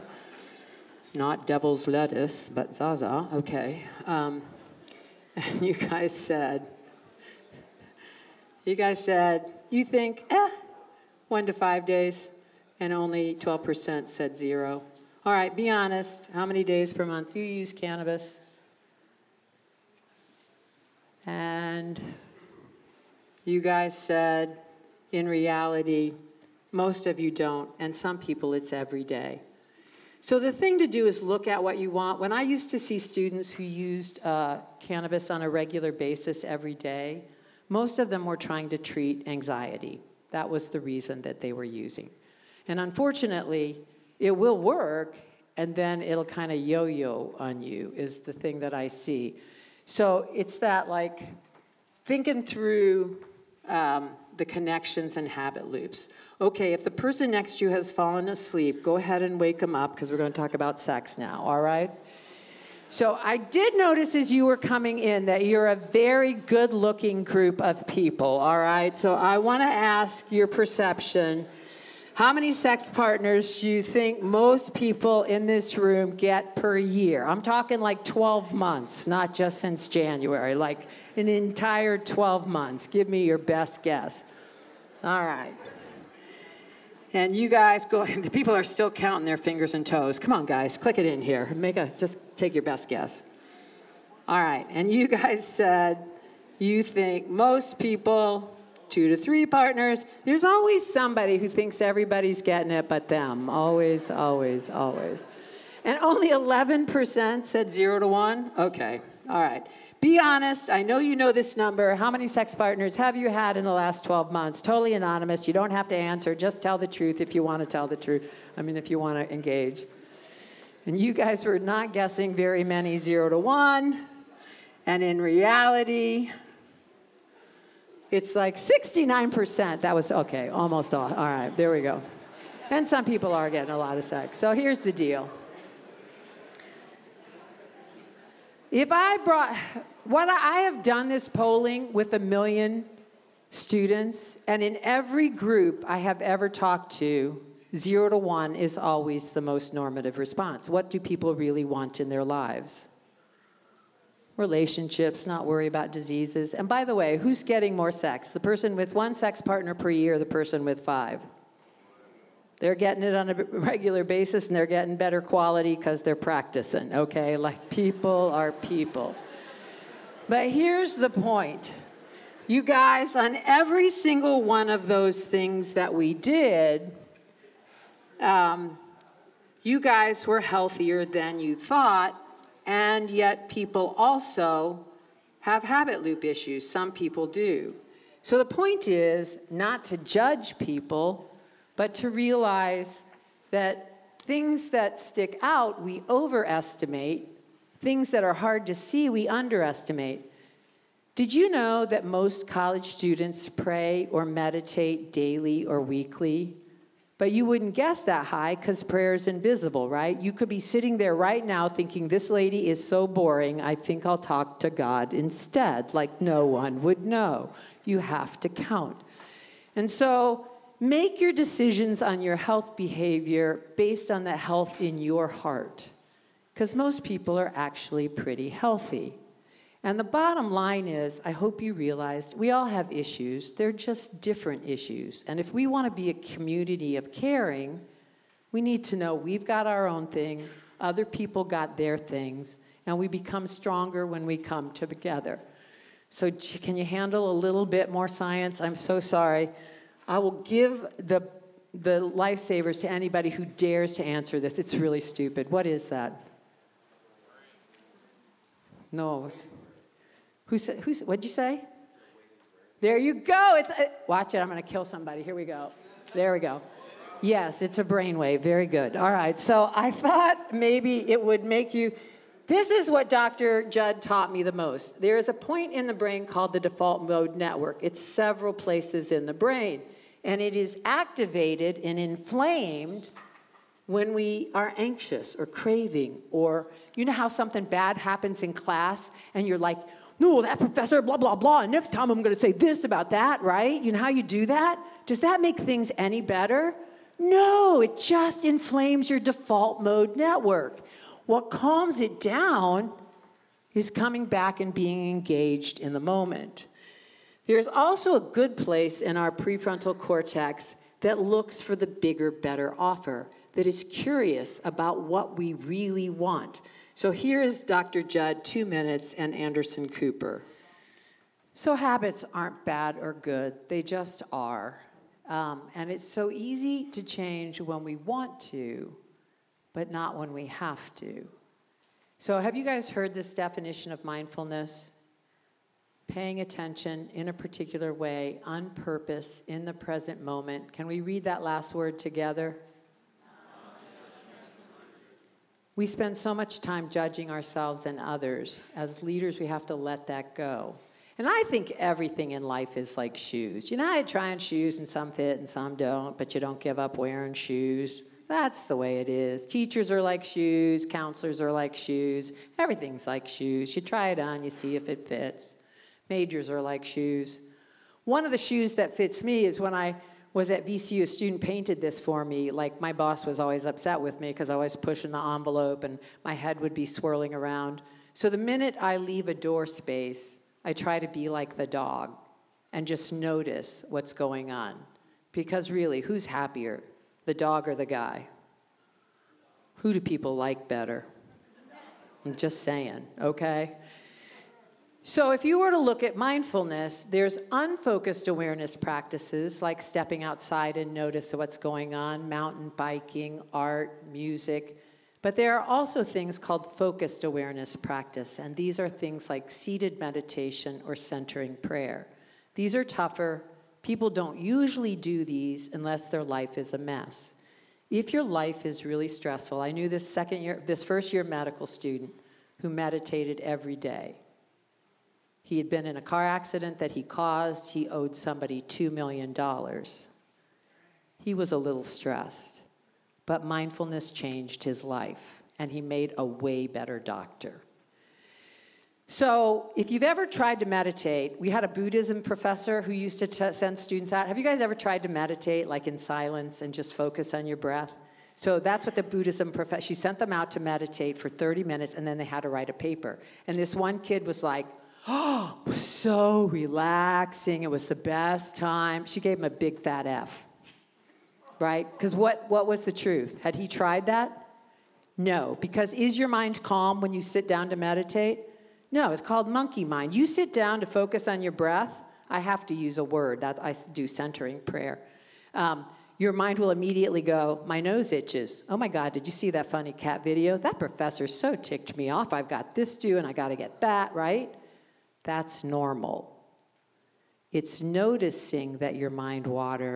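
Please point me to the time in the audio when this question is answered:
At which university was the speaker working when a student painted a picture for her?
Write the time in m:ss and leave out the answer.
6:10.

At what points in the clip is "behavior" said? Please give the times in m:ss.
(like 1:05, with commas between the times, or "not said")
3:42.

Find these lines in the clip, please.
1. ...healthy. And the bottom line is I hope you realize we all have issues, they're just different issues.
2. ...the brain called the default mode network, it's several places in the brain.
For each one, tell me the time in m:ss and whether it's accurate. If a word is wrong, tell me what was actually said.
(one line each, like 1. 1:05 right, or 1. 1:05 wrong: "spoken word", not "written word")
1. 3:48 right
2. 4:35 right.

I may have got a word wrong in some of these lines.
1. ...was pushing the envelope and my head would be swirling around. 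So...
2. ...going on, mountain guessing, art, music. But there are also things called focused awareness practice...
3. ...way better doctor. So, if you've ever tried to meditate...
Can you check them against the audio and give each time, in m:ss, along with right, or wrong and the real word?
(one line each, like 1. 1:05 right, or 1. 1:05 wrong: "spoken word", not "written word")
1. 6:14 right
2. 6:41 wrong: "biking", not "guessing"
3. 7:16 right.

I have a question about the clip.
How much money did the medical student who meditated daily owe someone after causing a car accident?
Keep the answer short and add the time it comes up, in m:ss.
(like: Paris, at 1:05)
$2 million, at 7:08.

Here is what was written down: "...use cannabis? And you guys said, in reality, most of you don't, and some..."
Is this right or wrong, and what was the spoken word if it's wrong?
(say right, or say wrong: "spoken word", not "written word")
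right.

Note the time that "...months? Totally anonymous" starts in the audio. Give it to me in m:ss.
1:54.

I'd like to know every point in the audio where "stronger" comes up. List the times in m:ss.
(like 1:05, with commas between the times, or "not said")
4:03.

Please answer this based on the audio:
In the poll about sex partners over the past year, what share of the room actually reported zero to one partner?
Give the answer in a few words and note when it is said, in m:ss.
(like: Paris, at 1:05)
69%, at 2:08.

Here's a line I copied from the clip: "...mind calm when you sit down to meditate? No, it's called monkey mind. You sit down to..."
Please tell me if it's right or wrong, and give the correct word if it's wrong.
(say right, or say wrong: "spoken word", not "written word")
right.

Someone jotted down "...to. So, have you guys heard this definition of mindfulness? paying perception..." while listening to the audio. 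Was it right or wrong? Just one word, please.
wrong.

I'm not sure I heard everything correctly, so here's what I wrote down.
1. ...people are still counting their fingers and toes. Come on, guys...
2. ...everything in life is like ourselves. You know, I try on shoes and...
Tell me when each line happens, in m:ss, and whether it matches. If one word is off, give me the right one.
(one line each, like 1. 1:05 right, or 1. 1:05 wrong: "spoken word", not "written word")
1. 1:28 right
2. 5:51 wrong: "shoes", not "ourselves".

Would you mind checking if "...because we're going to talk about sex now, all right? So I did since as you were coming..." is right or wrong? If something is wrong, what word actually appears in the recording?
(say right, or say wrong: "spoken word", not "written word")
wrong: "notice", not "since".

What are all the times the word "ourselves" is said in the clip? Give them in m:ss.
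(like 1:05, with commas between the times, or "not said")
5:47.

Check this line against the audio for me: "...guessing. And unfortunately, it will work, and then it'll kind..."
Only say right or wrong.
wrong.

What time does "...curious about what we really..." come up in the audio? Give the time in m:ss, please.
5:13.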